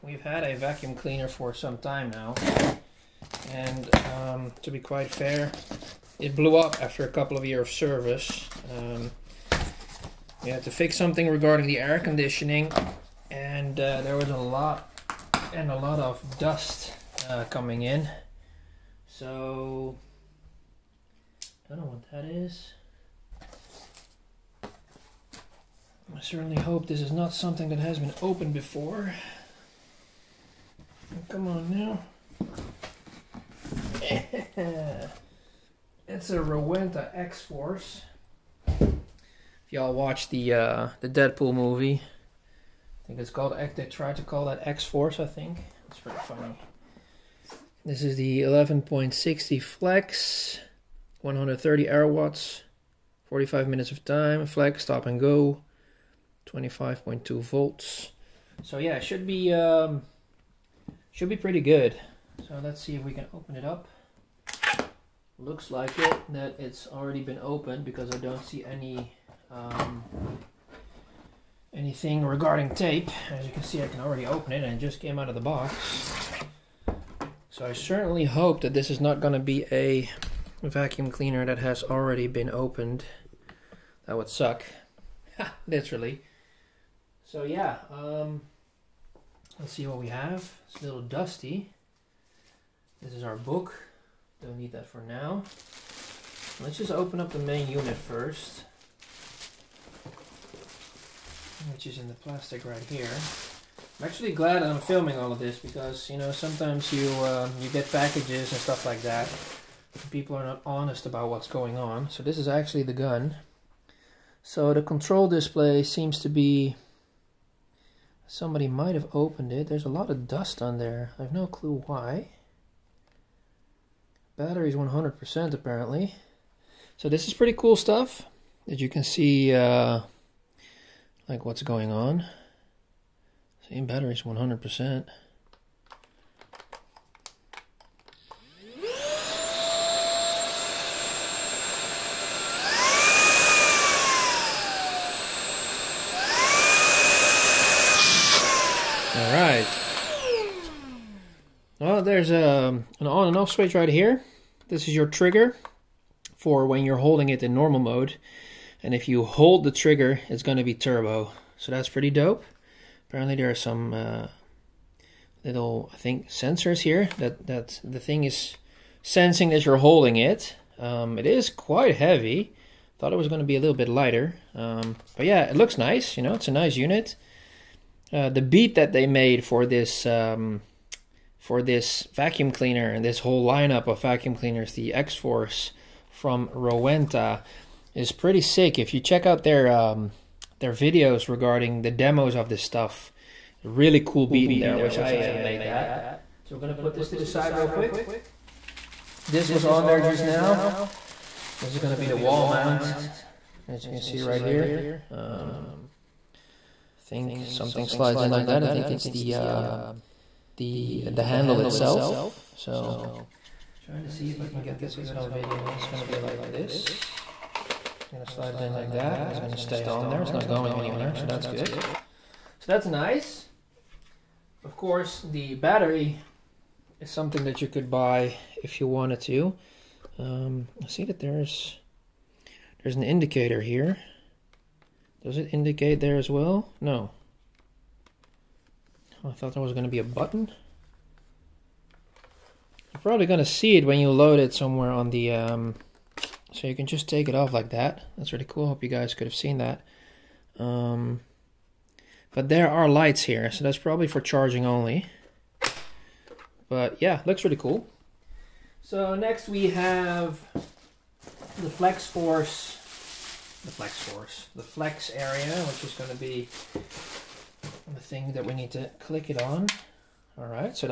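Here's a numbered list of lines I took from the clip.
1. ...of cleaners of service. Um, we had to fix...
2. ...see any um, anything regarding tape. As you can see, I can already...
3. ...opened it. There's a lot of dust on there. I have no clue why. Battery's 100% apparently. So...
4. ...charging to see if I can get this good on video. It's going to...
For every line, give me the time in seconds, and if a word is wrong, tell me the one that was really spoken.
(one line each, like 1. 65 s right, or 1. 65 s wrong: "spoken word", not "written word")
1. 7 s wrong: "years", not "cleaners"
2. 68 s right
3. 119 s right
4. 213 s wrong: "trying", not "charging".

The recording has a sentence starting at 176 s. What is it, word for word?
You know, it's a nice unit.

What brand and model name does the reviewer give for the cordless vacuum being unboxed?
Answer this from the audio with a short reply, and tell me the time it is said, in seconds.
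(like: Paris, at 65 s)
Rowenta X-Force, at 36 s.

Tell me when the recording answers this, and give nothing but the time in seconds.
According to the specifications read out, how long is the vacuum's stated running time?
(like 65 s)
53 s.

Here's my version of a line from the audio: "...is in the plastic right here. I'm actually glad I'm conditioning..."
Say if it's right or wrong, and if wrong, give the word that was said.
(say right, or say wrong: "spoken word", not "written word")
wrong: "filming", not "conditioning".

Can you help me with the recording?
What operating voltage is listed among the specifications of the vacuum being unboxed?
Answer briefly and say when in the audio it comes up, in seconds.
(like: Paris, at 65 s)
25.2 volts, at 56 s.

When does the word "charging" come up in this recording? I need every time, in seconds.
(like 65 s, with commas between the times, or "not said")
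254 s.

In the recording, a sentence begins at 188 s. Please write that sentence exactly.
If you check out their um, their videos regarding the demos of this stuff.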